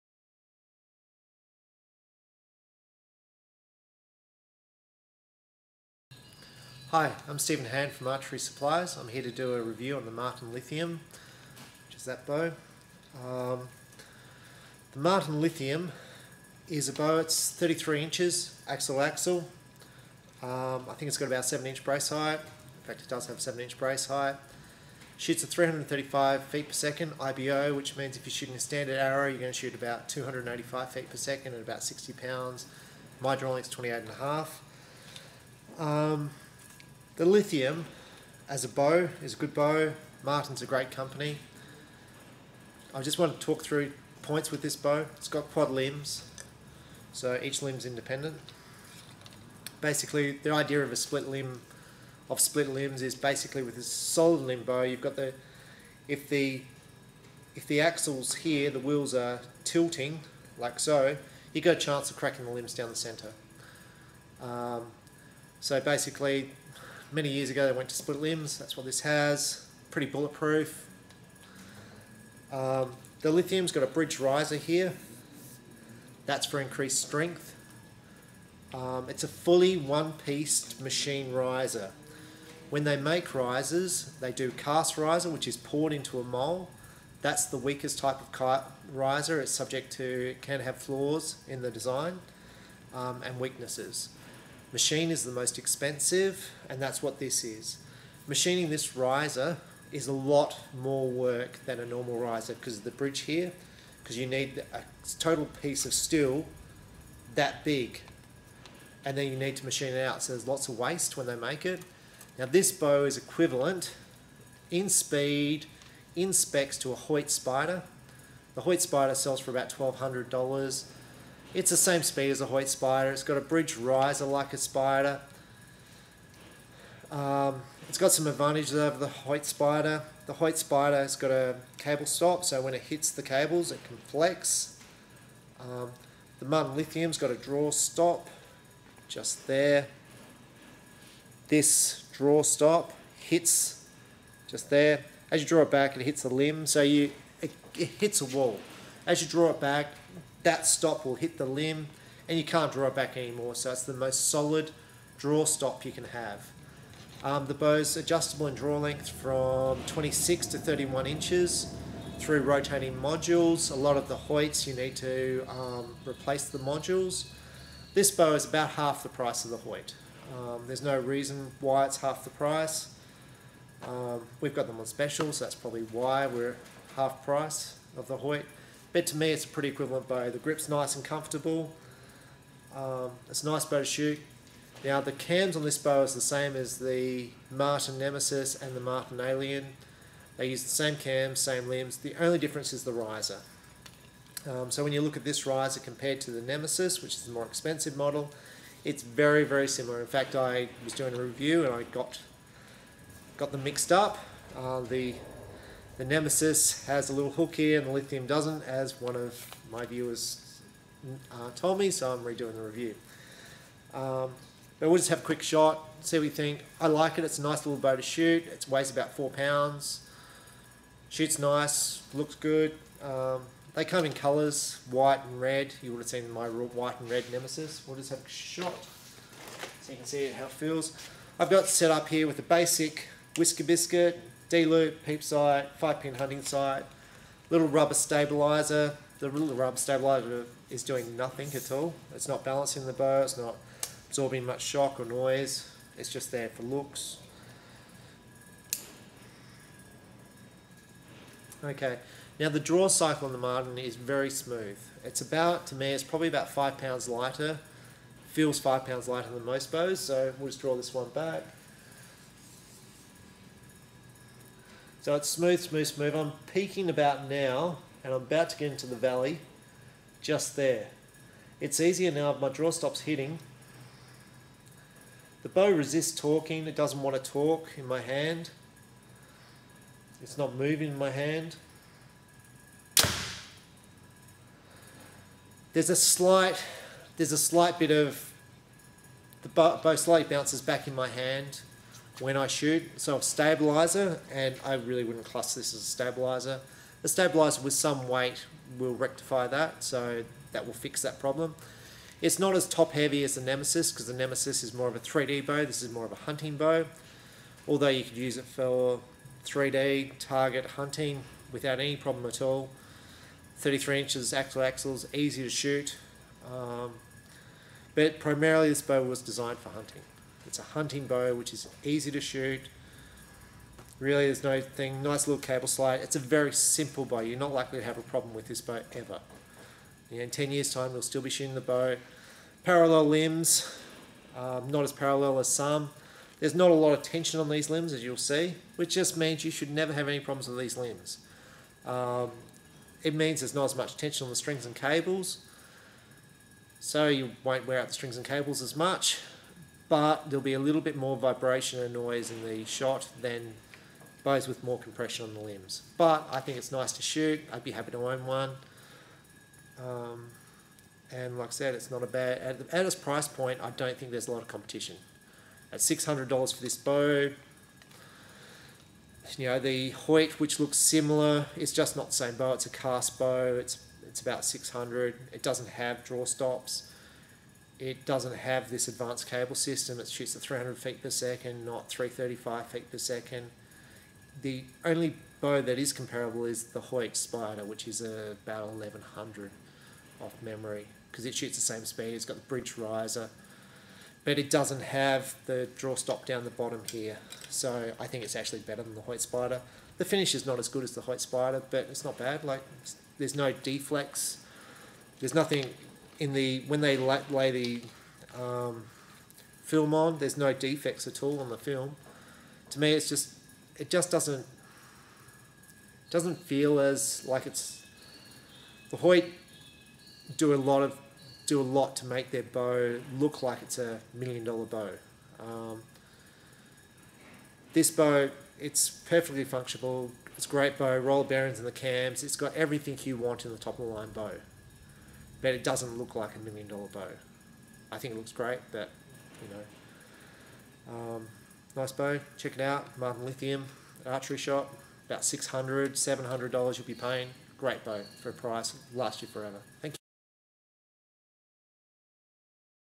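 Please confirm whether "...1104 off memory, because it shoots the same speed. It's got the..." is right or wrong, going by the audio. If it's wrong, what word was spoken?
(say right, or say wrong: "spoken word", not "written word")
wrong: "1100", not "1104".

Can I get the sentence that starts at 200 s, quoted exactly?
In fact, I was doing a review and I got got them mixed up.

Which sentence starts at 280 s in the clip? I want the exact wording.
It's not moving in my hand.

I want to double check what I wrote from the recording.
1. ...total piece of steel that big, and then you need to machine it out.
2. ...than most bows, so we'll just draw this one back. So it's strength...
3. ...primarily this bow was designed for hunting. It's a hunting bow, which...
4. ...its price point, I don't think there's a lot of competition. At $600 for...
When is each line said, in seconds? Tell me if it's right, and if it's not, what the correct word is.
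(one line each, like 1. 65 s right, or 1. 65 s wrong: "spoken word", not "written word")
1. 105 s right
2. 259 s wrong: "smooth", not "strength"
3. 318 s right
4. 362 s right.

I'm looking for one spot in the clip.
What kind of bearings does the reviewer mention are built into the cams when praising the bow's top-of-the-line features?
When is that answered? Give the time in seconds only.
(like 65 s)
430 s.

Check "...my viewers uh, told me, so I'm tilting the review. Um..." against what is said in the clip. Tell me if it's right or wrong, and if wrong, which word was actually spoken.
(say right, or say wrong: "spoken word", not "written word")
wrong: "redoing", not "tilting".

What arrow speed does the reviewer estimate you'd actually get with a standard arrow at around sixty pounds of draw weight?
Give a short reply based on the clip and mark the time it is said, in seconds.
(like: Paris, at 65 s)
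285 feet per second, at 30 s.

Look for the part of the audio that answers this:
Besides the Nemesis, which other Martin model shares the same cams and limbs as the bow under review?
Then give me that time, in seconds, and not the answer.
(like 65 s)
188 s.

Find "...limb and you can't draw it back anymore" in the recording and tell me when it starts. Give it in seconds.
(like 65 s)
151 s.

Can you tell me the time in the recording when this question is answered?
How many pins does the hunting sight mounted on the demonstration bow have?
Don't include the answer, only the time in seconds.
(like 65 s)
235 s.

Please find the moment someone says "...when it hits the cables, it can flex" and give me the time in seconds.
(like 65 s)
132 s.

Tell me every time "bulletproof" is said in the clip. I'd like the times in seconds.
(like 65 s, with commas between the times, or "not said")
70 s.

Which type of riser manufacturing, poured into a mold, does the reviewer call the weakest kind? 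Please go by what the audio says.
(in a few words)
Cast riser.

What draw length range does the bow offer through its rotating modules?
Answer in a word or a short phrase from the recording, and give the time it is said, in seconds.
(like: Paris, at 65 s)
26 to 31 inches, at 159 s.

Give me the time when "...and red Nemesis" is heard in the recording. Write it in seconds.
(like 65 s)
226 s.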